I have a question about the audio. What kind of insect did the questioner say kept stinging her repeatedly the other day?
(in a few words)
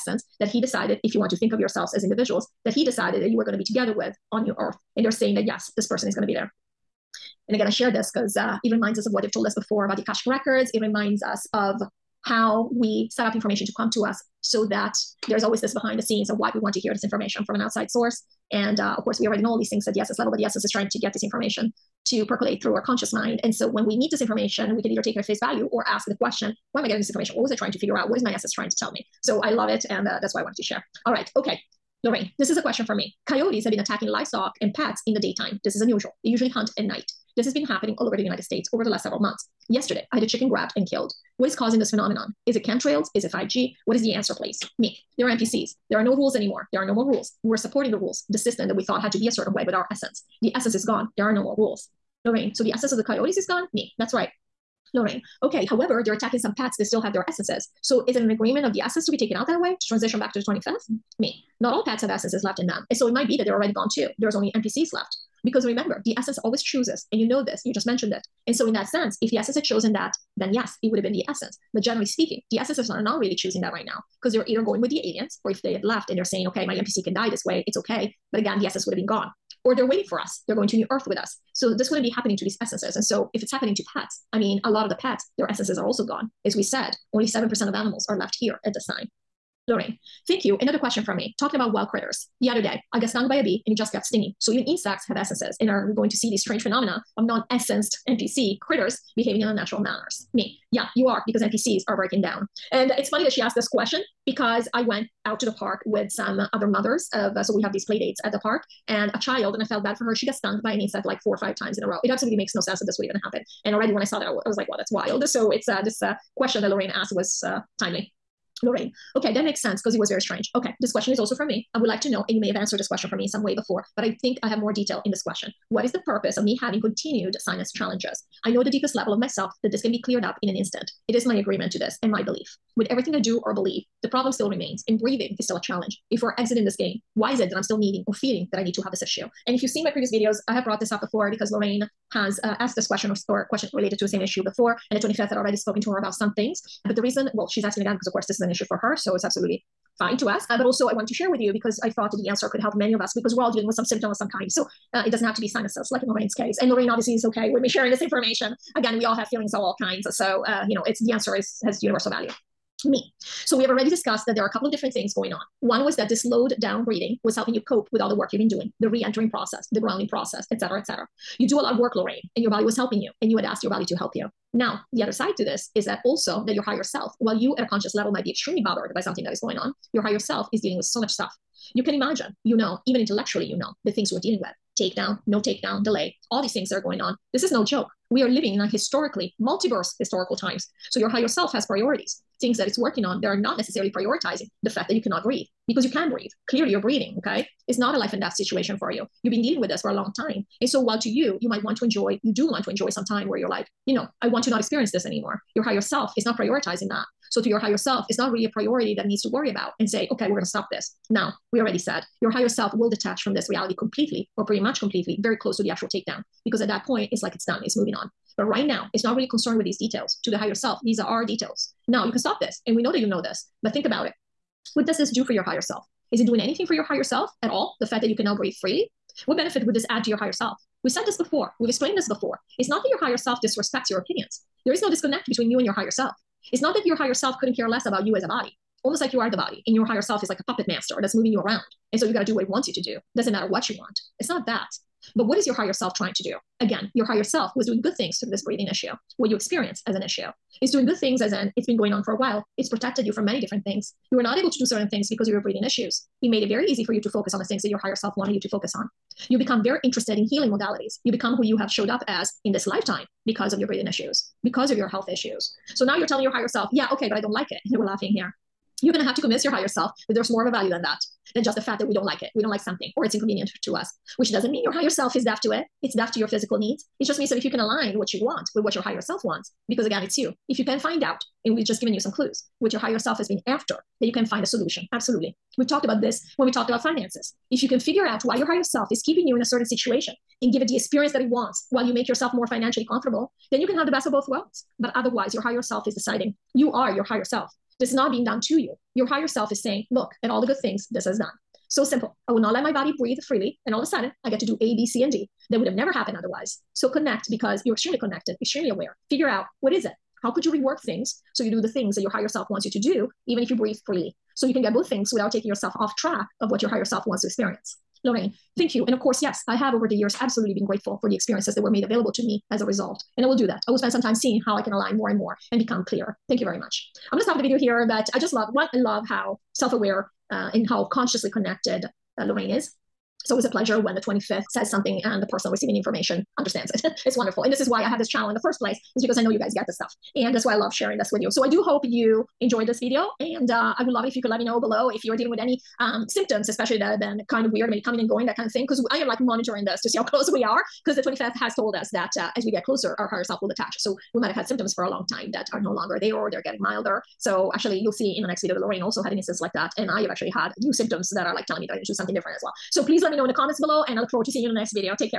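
A bee.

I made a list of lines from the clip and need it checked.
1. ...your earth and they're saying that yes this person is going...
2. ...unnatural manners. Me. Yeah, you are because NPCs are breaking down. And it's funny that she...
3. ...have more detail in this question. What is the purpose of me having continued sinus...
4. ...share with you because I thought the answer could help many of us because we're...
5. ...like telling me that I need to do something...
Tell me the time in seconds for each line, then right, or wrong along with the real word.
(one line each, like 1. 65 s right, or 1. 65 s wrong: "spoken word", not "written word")
1. 4 s right
2. 99 s right
3. 124 s right
4. 151 s right
5. 361 s right.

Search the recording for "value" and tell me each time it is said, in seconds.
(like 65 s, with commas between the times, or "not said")
25 s, 162 s, 270 s.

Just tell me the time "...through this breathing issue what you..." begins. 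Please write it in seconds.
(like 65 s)
248 s.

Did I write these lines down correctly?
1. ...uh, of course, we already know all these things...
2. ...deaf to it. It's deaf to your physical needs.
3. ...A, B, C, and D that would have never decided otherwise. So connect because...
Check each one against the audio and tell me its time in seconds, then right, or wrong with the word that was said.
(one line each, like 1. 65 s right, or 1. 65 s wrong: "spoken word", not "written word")
1. 18 s right
2. 275 s right
3. 304 s wrong: "happened", not "decided".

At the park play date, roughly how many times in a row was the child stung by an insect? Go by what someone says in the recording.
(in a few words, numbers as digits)
4 or 5 times.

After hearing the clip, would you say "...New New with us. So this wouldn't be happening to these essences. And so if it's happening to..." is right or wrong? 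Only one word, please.
wrong.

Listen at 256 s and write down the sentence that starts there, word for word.
It made it very easy for you to focus on the things that your higher self wanted you to focus on.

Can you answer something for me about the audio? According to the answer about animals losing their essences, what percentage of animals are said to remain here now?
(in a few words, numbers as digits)
7%.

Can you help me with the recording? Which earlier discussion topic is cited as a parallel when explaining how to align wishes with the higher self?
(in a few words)
Finances.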